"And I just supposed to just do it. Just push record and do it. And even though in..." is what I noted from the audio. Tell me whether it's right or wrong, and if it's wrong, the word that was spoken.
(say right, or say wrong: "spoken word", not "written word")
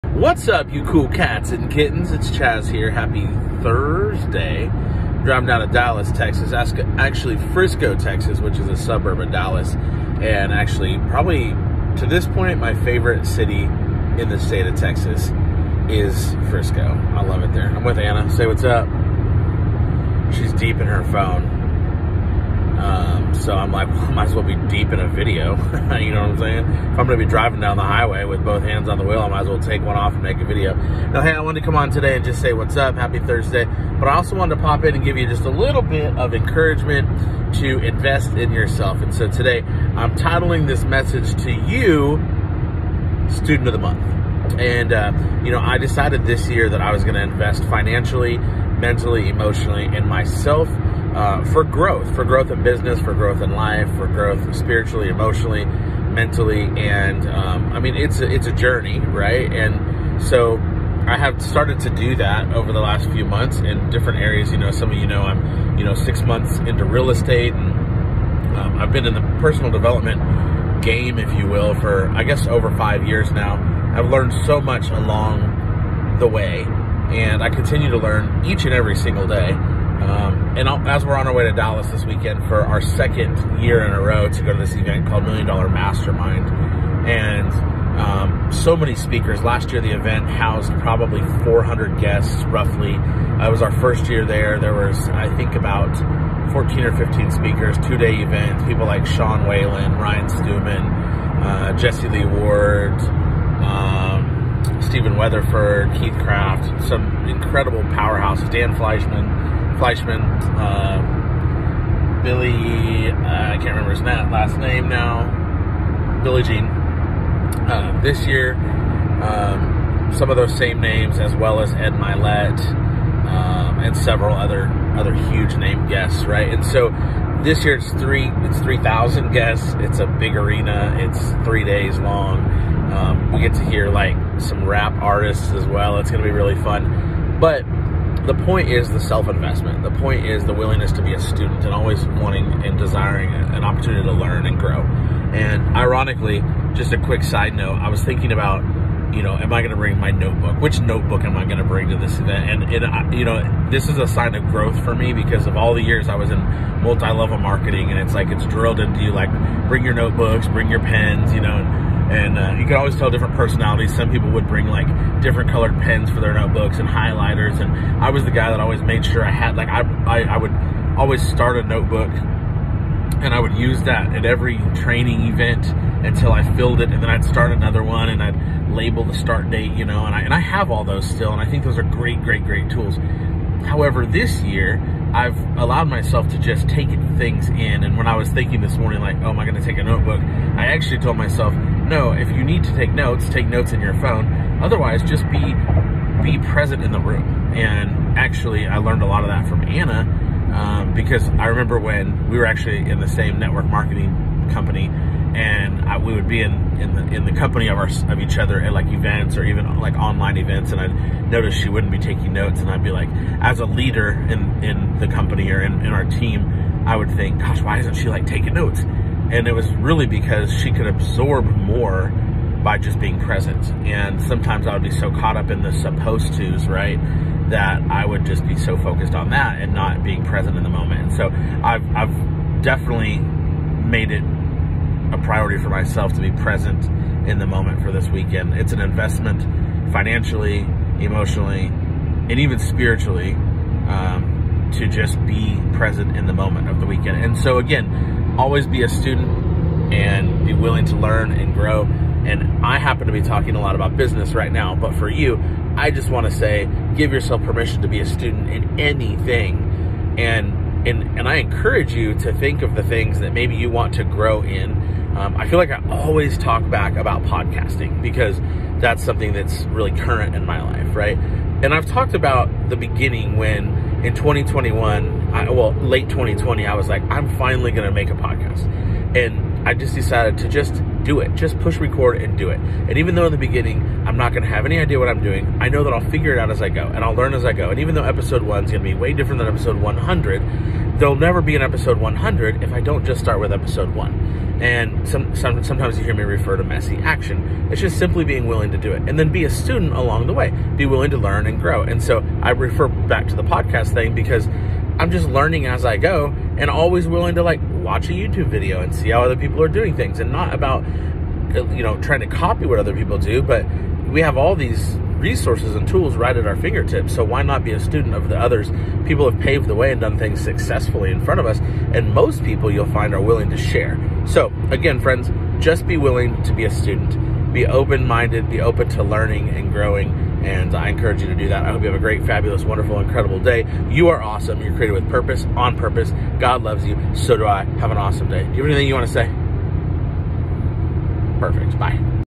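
wrong: "decided", not "supposed".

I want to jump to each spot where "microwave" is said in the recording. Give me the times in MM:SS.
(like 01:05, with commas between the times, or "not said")
not said.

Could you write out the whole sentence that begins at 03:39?
And it was really because she could absorb more by just being present.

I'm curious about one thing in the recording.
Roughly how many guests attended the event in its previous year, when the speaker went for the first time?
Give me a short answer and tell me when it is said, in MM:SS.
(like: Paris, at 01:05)
400, at 01:31.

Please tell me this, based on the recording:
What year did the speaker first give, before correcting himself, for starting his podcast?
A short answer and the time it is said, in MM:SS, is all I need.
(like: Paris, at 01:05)
2021, at 04:34.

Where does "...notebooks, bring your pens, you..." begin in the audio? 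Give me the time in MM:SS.
02:39.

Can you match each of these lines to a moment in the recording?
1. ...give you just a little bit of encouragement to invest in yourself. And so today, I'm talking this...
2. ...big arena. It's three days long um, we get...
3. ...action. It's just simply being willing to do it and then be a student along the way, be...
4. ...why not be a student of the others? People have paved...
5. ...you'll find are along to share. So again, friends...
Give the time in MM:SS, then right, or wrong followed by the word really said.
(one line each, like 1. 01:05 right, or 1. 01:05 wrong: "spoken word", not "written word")
1. 00:35 wrong: "titling", not "talking"
2. 02:10 right
3. 04:56 right
4. 05:17 right
5. 05:22 wrong: "willing", not "along".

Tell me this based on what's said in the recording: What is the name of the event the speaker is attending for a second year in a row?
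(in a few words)
Million Dollar Mastermind.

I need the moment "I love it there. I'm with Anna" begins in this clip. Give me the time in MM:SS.
00:17.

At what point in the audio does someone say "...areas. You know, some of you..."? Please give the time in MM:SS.
01:04.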